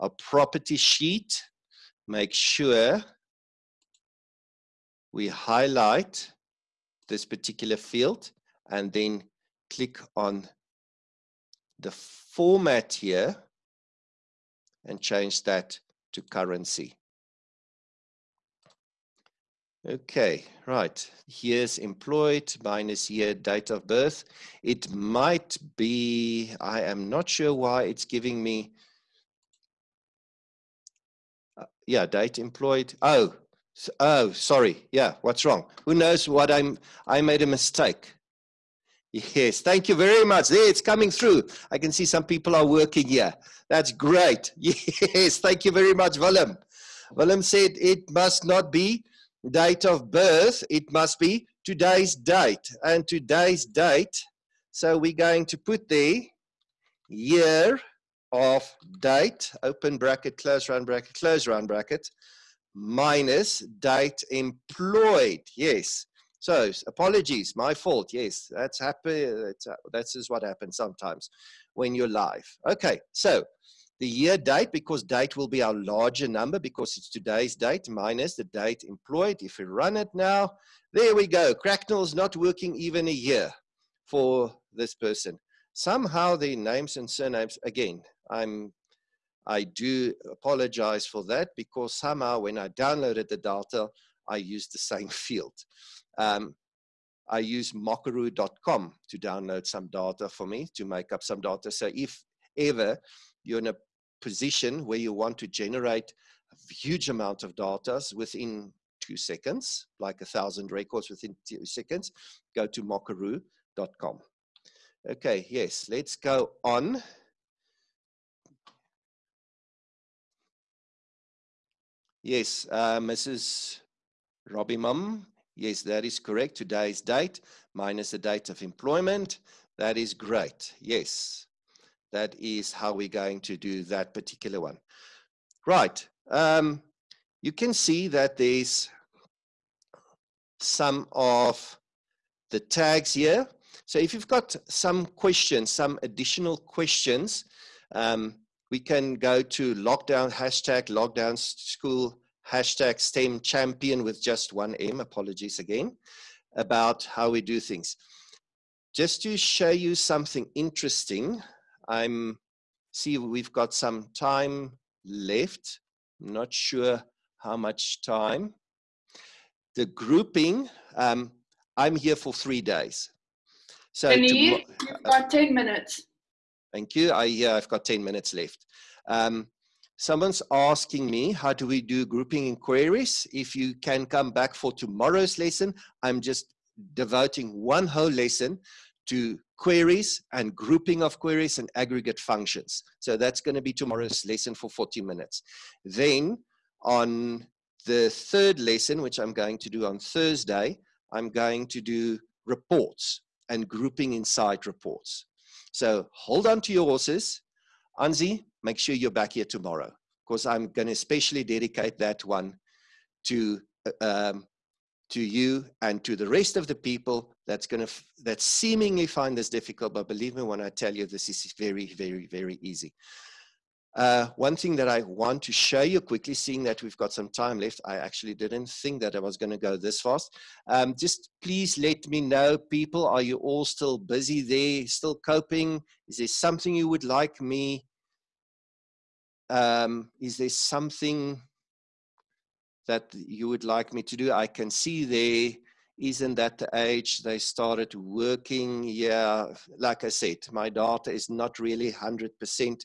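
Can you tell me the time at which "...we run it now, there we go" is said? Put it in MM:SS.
01:19.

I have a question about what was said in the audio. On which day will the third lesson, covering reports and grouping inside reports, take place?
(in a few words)
Thursday.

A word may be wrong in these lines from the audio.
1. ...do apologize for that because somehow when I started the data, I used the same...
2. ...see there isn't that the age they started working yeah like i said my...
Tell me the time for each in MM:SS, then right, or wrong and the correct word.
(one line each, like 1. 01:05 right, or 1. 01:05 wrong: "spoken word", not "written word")
1. 01:29 wrong: "downloaded", not "started"
2. 04:04 right.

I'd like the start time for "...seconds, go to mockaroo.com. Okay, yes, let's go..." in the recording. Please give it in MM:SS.
01:51.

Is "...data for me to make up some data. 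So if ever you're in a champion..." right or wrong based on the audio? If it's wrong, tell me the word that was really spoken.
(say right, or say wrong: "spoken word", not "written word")
wrong: "position", not "champion".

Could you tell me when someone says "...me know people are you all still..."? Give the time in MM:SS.
03:52.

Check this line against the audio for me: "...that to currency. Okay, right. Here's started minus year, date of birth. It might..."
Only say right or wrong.
wrong.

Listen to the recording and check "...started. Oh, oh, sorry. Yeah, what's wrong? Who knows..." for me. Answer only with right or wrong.
wrong.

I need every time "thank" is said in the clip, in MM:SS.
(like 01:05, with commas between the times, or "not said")
00:39, 00:45, 02:56.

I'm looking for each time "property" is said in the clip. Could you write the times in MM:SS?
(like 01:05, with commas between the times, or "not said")
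00:00.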